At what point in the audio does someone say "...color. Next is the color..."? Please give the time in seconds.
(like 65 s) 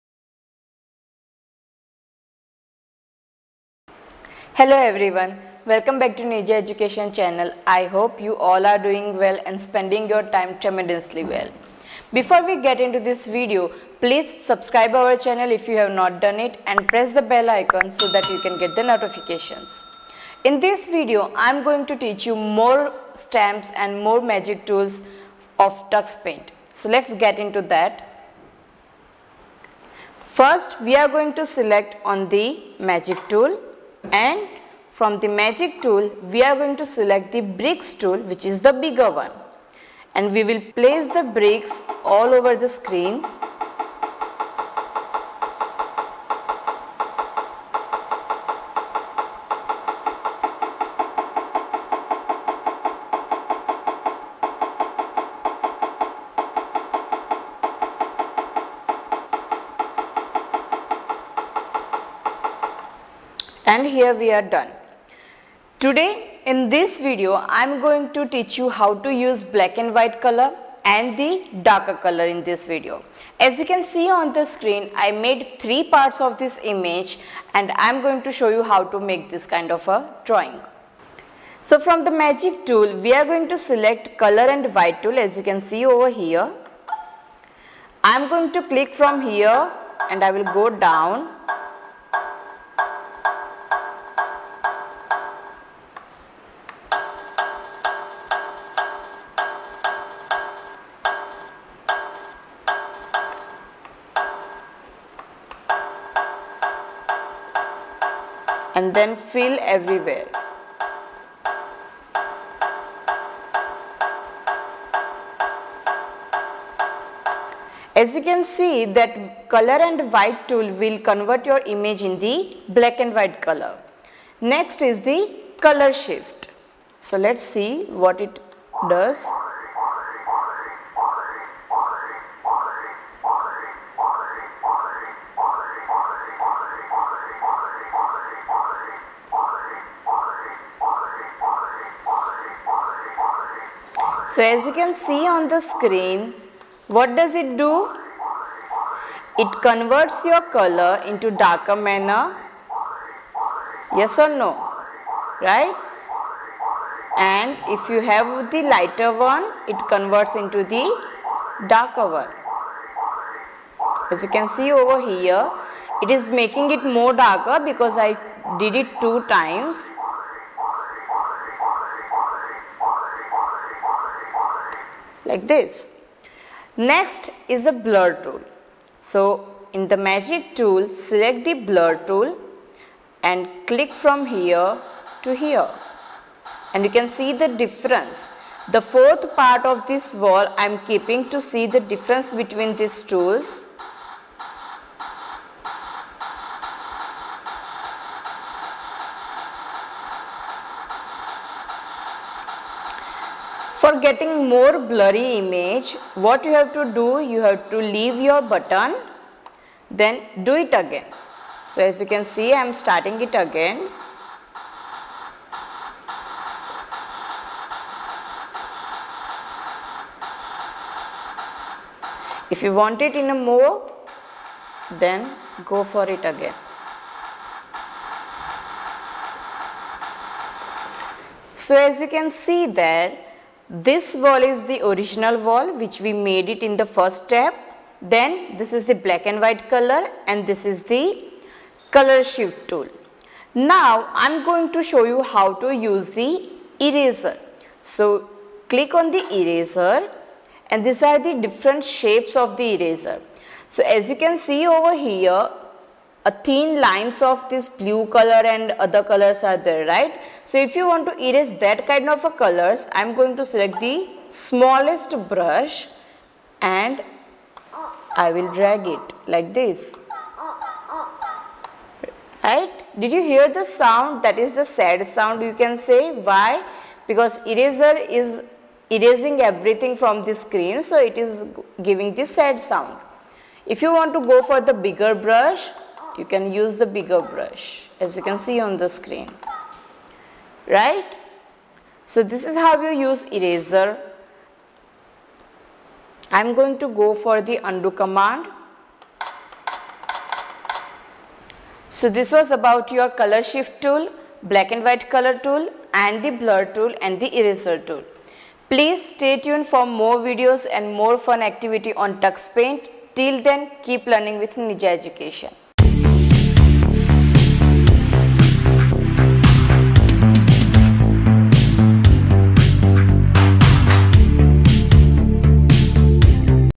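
123 s.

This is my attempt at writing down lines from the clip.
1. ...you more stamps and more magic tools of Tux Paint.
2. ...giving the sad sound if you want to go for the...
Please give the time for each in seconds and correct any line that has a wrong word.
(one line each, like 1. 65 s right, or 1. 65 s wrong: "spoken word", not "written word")
1. 22 s right
2. 281 s right.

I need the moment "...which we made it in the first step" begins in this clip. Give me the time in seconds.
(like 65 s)
235 s.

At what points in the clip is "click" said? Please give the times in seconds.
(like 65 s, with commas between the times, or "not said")
88 s, 183 s, 248 s.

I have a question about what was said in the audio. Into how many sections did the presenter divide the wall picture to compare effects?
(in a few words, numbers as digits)
3.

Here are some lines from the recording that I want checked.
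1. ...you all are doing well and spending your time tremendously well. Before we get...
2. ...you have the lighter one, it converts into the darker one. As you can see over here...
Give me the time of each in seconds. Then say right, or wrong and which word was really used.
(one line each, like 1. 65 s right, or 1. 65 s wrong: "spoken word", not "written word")
1. 8 s right
2. 157 s right.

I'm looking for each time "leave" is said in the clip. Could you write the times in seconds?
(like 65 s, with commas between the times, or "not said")
207 s.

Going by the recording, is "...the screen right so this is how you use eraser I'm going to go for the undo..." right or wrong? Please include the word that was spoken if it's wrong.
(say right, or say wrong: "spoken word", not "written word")
right.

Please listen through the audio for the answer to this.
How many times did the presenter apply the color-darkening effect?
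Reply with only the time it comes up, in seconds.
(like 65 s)
169 s.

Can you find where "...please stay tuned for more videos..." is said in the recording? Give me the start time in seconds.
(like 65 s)
308 s.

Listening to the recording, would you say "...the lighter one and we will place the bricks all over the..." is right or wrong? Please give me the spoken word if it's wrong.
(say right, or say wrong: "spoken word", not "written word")
wrong: "bigger", not "lighter".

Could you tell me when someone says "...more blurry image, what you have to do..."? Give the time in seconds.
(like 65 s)
204 s.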